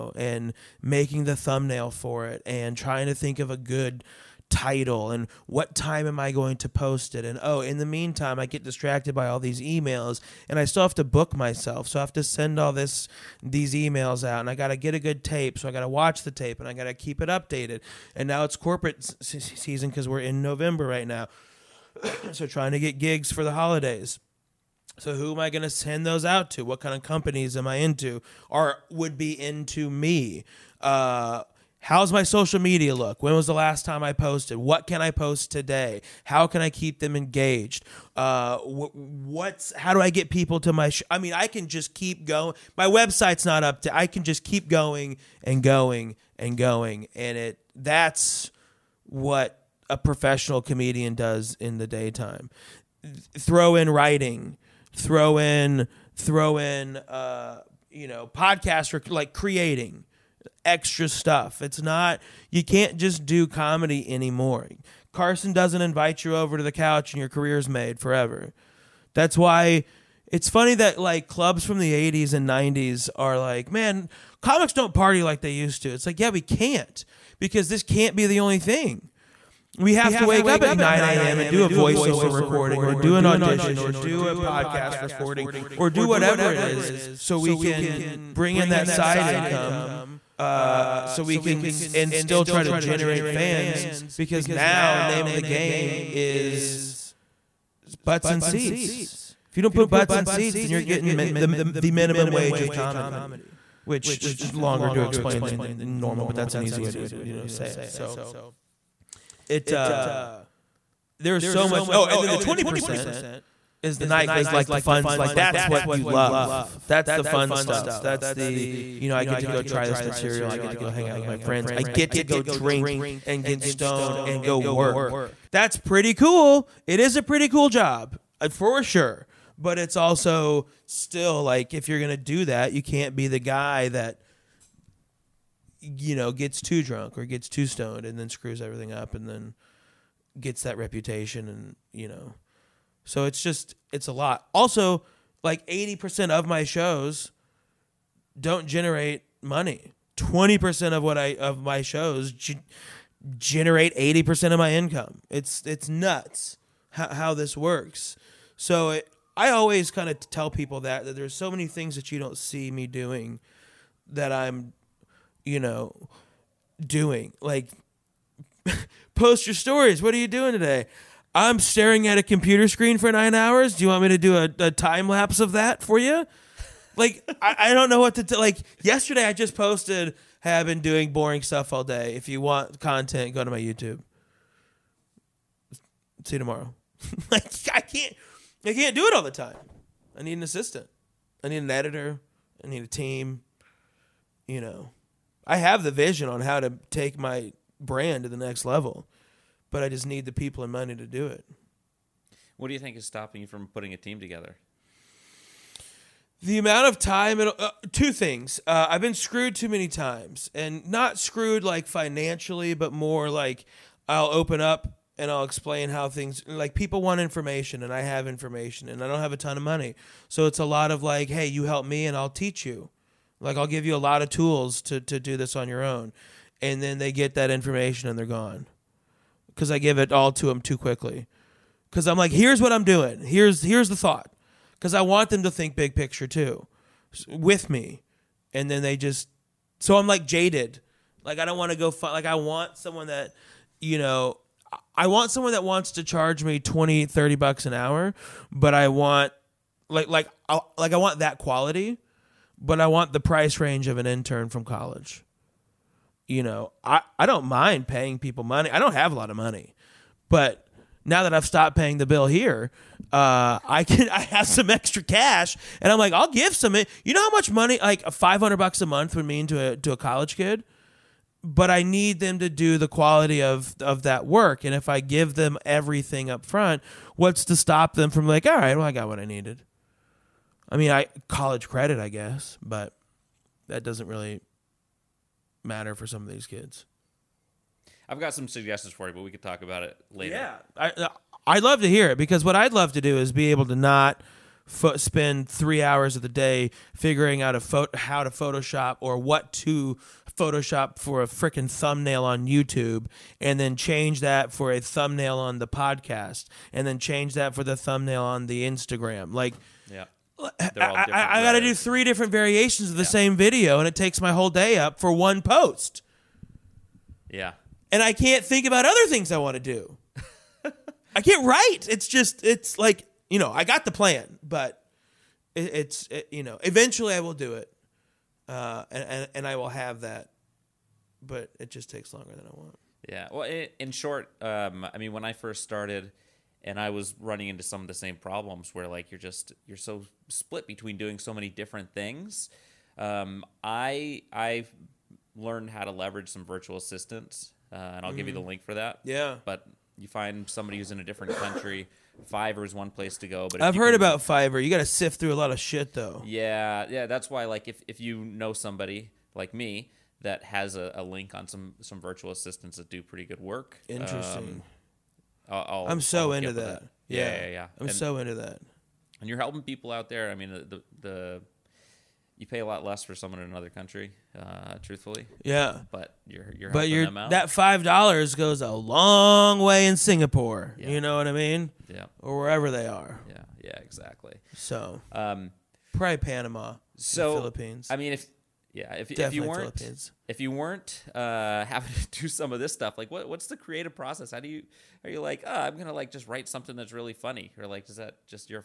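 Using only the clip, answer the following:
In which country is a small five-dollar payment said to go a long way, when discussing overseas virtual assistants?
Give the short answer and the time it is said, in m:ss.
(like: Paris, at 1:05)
Singapore, at 6:19.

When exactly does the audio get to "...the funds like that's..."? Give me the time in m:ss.
1:54.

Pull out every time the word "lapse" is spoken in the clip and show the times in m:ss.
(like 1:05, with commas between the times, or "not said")
2:55.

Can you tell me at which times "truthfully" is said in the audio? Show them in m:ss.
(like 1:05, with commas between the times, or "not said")
6:14.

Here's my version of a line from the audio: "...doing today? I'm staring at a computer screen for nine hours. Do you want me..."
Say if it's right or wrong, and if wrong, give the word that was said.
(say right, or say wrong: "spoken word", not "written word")
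right.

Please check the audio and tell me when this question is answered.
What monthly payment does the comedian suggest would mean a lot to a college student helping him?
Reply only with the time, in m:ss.
4:28.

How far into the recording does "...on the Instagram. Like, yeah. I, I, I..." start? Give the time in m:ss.
5:08.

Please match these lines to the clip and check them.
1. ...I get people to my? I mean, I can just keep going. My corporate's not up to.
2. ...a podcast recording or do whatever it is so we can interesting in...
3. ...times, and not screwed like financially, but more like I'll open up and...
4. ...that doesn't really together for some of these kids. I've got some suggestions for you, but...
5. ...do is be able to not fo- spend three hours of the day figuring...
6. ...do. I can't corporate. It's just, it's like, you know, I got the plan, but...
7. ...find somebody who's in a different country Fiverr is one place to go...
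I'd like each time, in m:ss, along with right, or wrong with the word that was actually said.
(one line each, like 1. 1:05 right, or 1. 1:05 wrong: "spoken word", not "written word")
1. 0:39 wrong: "website", not "corporate"
2. 1:24 wrong: "bring", not "interesting"
3. 3:29 right
4. 4:43 wrong: "matter", not "together"
5. 4:53 right
6. 5:19 wrong: "write", not "corporate"
7. 5:50 right.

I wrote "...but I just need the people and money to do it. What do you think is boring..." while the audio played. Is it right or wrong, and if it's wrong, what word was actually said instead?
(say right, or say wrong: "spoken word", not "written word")
wrong: "stopping", not "boring".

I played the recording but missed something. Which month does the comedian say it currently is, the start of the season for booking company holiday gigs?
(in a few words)
November.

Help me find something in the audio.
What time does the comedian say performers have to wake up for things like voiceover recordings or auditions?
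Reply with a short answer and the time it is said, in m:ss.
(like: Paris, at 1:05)
9 a.m., at 1:20.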